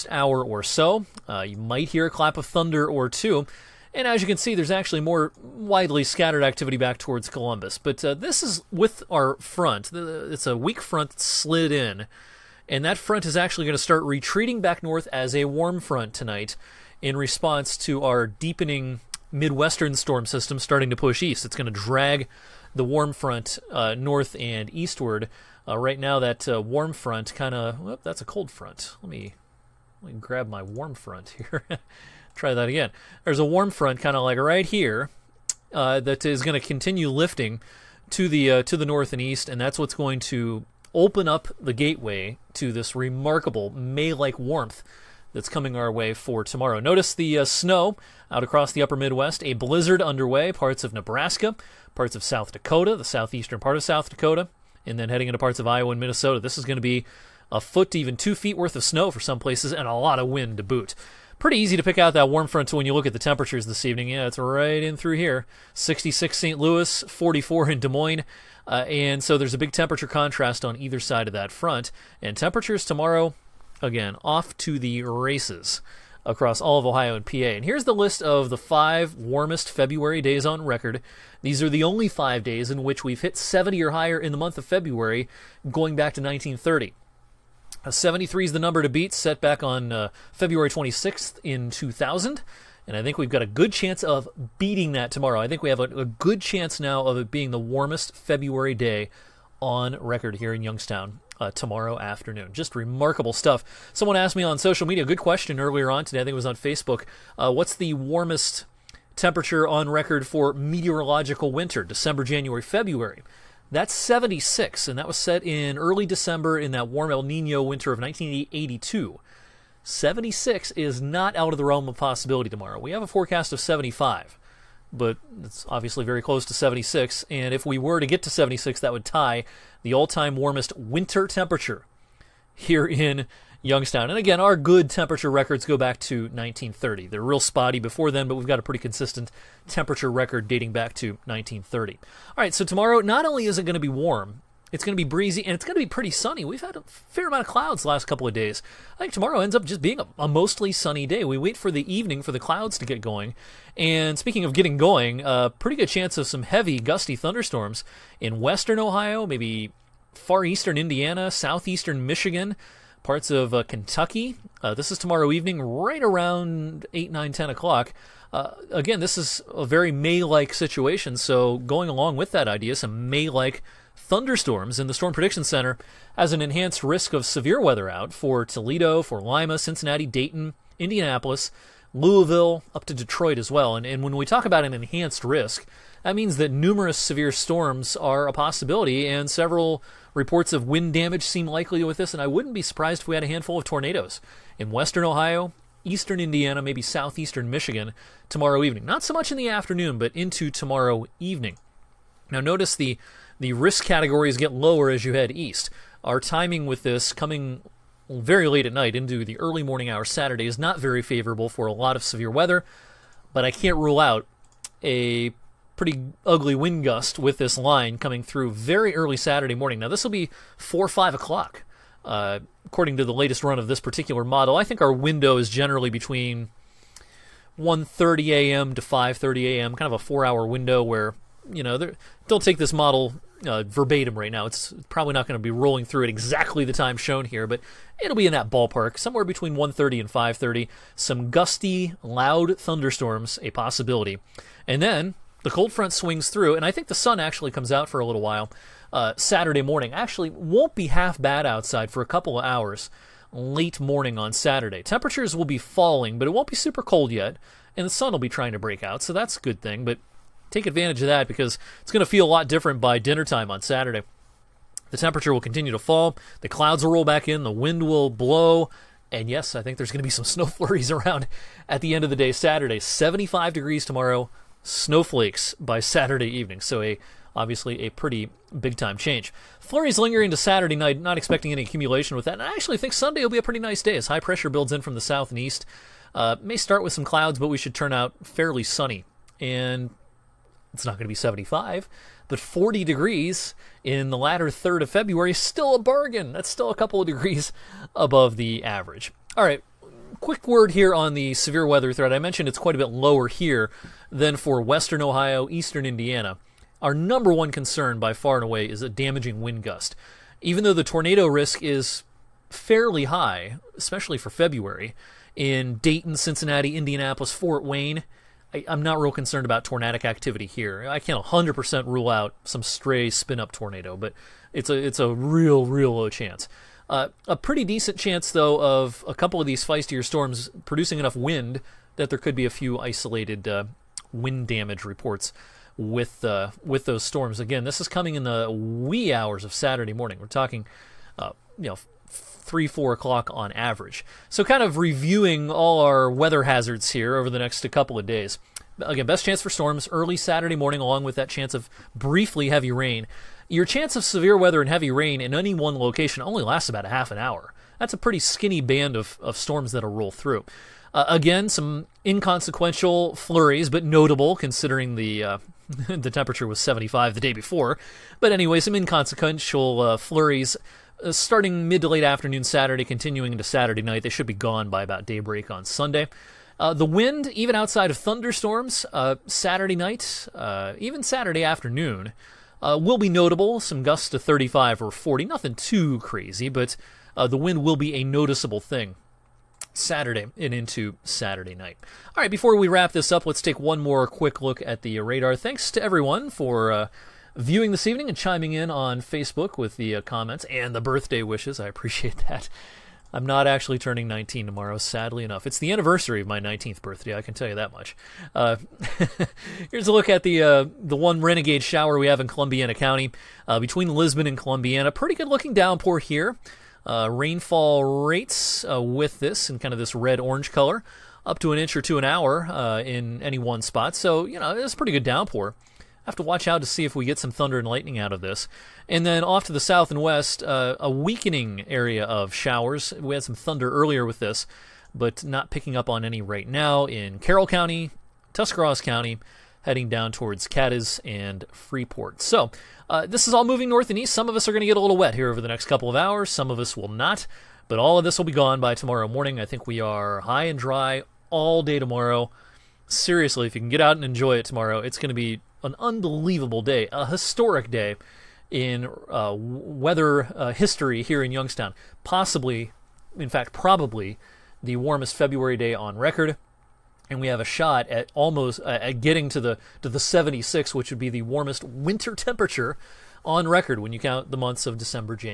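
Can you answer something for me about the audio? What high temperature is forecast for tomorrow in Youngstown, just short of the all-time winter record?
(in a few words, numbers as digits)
75.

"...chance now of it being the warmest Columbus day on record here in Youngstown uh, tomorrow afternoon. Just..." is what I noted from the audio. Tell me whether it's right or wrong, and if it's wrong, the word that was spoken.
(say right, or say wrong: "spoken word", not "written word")
wrong: "February", not "Columbus".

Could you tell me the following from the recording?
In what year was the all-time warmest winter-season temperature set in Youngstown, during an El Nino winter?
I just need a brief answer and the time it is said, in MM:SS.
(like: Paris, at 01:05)
1982, at 01:57.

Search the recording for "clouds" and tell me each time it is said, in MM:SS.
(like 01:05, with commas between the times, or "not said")
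02:27, 02:32, 04:26, 04:47.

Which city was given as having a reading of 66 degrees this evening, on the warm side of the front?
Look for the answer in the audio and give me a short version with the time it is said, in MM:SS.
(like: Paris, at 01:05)
St. Louis, at 01:05.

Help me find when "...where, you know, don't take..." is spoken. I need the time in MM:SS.
03:50.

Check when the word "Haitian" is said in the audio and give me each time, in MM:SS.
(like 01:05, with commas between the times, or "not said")
not said.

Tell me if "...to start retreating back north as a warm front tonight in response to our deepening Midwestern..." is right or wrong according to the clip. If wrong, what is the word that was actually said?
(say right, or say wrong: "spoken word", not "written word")
right.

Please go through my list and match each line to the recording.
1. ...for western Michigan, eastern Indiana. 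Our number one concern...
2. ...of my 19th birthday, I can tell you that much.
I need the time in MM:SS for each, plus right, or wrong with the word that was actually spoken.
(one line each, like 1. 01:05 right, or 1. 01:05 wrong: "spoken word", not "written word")
1. 05:04 wrong: "Ohio", not "Michigan"
2. 06:46 right.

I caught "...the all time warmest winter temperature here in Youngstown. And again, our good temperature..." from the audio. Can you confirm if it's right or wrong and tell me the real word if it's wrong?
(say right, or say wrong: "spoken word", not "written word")
right.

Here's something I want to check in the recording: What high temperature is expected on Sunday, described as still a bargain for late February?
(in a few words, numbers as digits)
40 degrees.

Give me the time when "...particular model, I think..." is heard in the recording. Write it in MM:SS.
03:43.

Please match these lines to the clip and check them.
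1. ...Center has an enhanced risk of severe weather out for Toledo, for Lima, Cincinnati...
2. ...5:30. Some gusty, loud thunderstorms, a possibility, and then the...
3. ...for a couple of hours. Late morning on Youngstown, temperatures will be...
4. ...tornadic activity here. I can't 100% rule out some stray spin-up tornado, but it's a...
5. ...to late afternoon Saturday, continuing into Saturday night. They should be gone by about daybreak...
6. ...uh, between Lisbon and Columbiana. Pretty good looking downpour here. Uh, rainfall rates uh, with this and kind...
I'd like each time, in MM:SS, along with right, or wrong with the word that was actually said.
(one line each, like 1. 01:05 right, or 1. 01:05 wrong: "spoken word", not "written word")
1. 02:55 right
2. 04:00 right
3. 04:11 wrong: "Saturday", not "Youngstown"
4. 05:19 right
5. 06:11 right
6. 06:53 right.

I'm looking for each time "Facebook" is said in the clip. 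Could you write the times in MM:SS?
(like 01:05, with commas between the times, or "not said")
01:46, 06:39.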